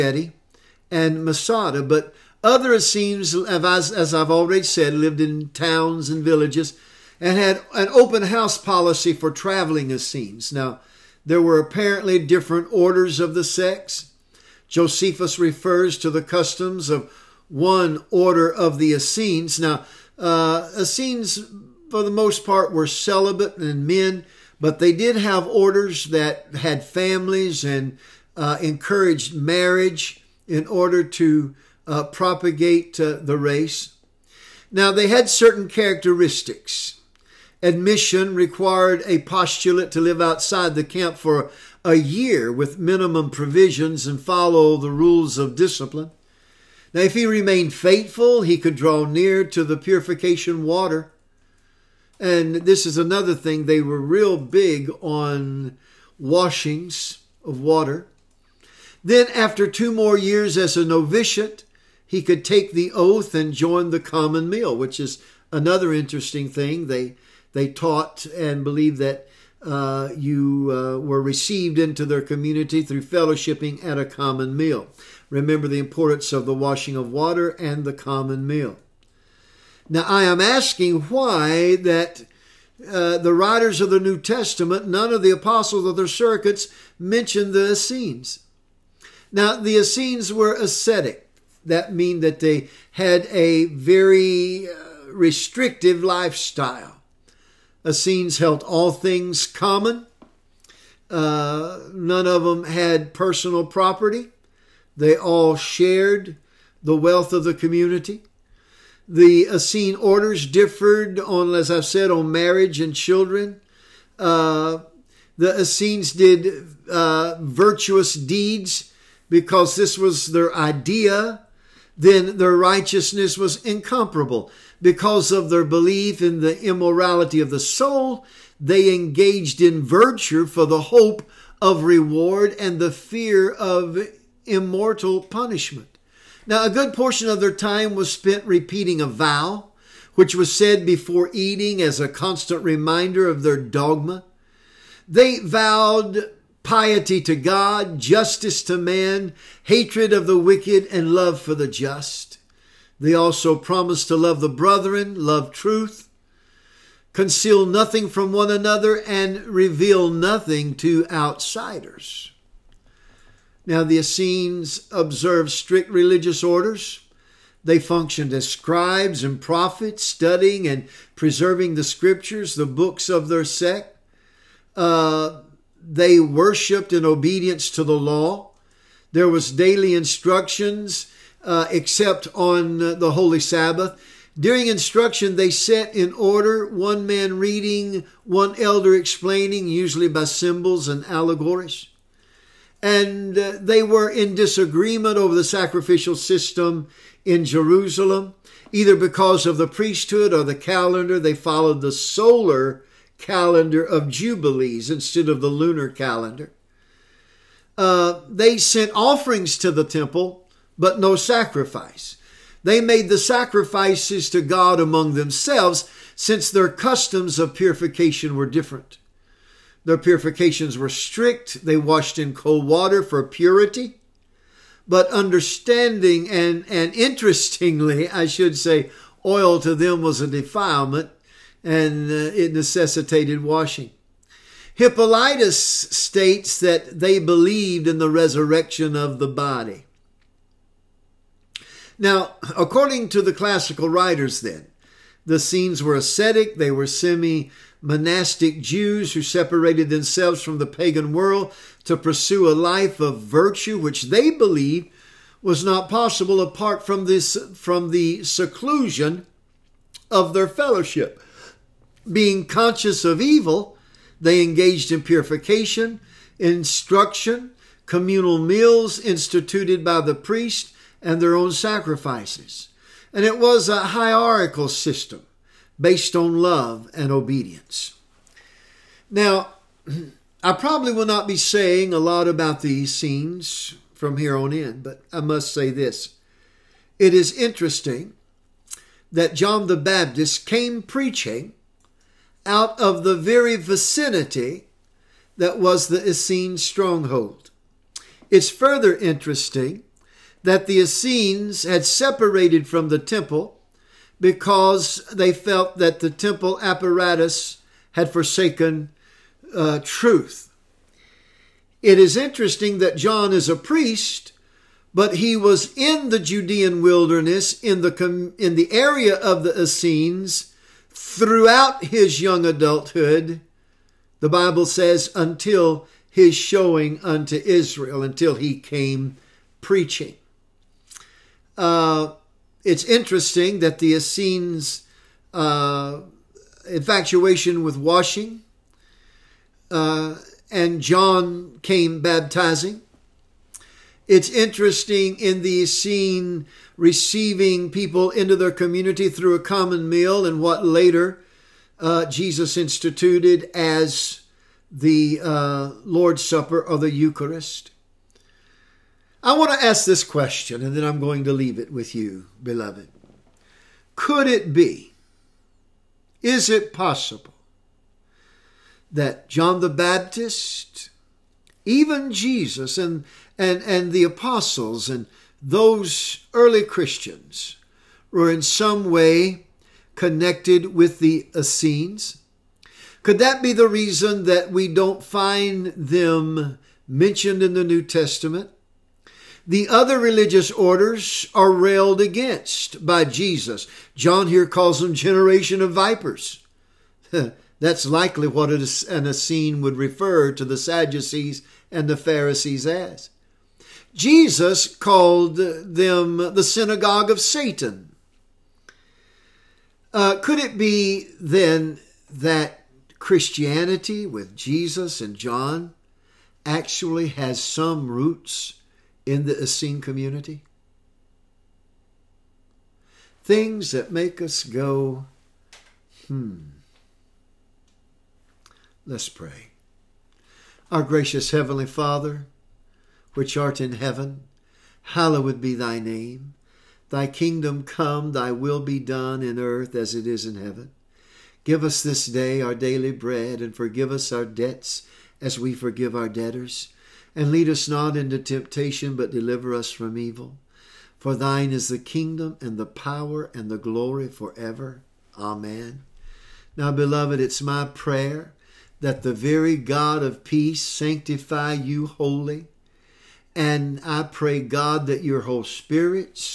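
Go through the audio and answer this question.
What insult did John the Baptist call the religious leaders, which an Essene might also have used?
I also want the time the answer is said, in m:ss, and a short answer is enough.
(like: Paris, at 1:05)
Generation of vipers, at 6:34.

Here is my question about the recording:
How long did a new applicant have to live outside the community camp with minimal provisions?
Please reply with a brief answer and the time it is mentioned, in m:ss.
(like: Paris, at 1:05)
A year, at 0:41.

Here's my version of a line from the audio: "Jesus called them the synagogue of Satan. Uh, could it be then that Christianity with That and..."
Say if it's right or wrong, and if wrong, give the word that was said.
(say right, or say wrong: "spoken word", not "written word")
wrong: "Jesus", not "That".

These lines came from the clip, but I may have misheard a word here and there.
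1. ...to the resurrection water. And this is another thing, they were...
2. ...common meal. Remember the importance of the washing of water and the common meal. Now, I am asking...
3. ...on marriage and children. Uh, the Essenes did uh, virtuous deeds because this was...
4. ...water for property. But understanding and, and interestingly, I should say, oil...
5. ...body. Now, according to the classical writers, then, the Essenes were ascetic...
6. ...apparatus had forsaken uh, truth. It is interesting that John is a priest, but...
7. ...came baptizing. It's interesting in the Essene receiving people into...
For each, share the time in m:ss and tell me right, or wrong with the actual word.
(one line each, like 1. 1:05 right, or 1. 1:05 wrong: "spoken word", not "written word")
1. 0:49 wrong: "purification", not "resurrection"
2. 1:14 right
3. 1:52 right
4. 3:42 wrong: "purity", not "property"
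5. 3:59 right
6. 5:06 right
7. 5:41 right.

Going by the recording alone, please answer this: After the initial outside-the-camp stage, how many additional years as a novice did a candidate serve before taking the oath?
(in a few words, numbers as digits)
2.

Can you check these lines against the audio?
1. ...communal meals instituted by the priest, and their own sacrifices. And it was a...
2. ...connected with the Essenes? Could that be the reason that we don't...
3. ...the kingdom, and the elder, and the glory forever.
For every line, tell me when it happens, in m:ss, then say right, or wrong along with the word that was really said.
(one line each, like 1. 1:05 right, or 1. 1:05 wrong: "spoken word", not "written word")
1. 4:27 right
2. 6:19 right
3. 7:31 wrong: "power", not "elder".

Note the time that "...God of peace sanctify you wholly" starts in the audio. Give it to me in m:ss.
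7:39.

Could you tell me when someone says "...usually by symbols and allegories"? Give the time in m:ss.
3:09.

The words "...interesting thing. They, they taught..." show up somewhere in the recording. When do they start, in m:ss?
1:05.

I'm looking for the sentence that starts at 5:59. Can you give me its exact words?
I want to ask this question, and then I'm going to leave it with you, beloved.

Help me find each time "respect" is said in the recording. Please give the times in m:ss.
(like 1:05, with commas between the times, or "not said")
not said.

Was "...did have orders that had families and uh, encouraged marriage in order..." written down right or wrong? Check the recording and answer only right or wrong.
right.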